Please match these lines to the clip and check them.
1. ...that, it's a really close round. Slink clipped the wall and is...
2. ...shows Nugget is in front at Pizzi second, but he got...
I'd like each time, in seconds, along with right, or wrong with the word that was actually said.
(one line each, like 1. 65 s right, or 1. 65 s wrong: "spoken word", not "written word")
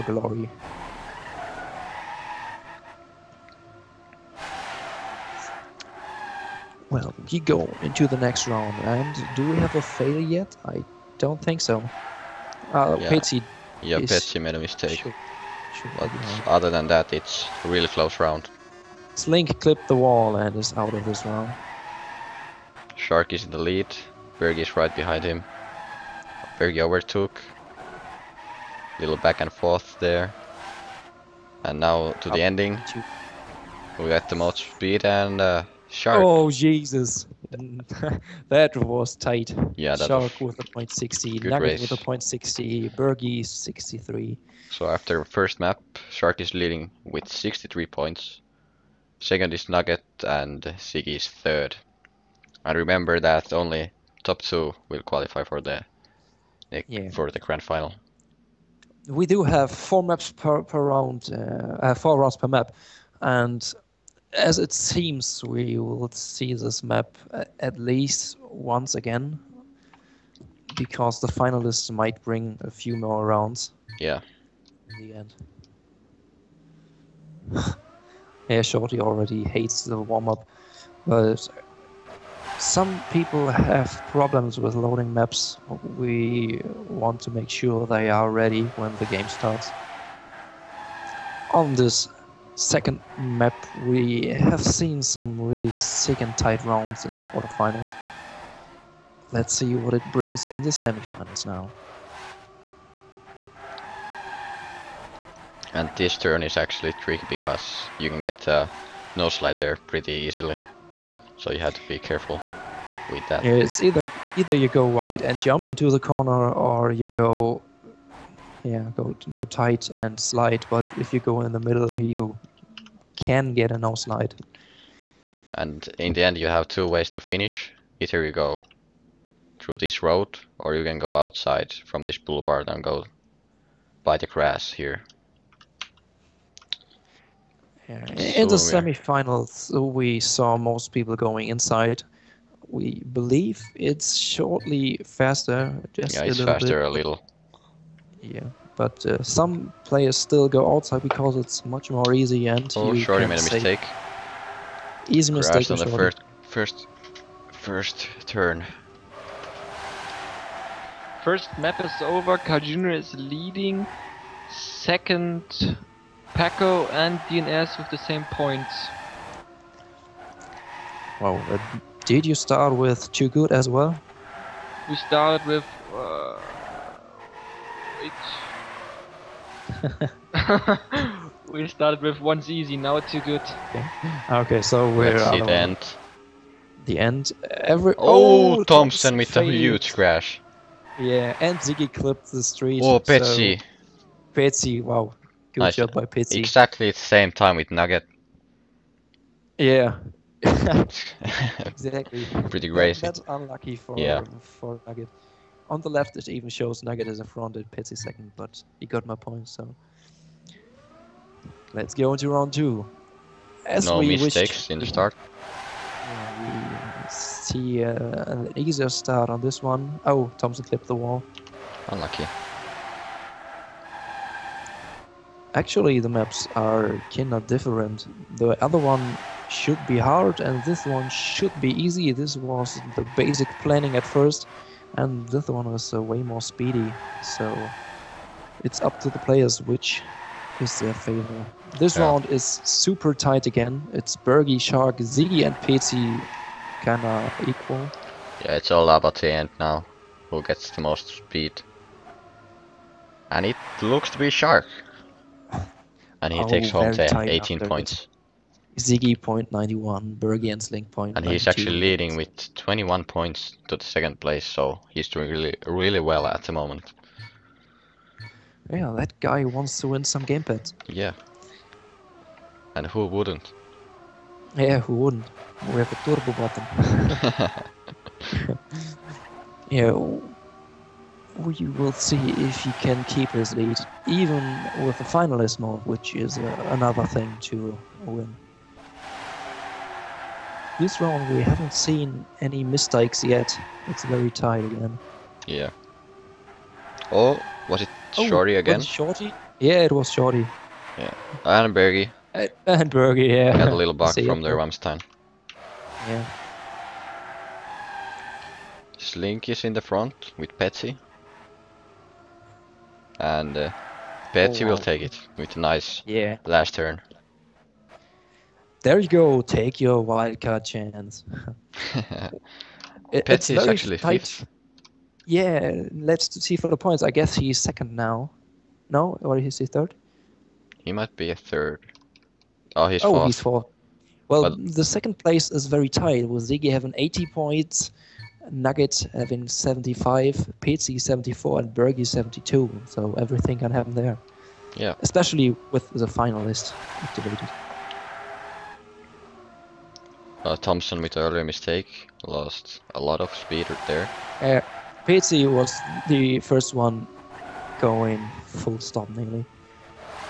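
1. 16 s right
2. 206 s right.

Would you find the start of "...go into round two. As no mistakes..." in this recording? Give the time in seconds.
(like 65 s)
211 s.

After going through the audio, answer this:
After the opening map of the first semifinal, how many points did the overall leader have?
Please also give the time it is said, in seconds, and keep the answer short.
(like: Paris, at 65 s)
63, at 46 s.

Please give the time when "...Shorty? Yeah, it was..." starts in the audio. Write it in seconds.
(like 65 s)
298 s.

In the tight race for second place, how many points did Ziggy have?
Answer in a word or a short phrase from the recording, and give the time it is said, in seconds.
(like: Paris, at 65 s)
80, at 336 s.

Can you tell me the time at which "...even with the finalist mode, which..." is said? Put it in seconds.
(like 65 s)
284 s.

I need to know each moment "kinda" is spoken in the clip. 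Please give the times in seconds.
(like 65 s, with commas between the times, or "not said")
227 s, 246 s.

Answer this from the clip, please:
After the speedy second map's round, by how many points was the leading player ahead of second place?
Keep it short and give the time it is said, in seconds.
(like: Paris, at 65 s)
21, at 262 s.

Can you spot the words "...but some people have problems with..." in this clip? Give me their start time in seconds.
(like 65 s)
81 s.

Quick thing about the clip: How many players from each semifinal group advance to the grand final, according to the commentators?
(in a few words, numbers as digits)
2.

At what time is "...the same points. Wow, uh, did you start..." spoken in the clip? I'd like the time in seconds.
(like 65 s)
167 s.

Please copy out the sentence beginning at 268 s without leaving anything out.
Yeah, that guy wants to win some gamepads.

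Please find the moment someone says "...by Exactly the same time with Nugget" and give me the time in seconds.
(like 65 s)
195 s.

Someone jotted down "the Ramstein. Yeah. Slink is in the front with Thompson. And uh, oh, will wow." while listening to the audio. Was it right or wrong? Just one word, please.
wrong.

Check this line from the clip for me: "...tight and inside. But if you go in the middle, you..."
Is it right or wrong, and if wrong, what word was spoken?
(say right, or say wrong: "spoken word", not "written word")
wrong: "slide", not "inside".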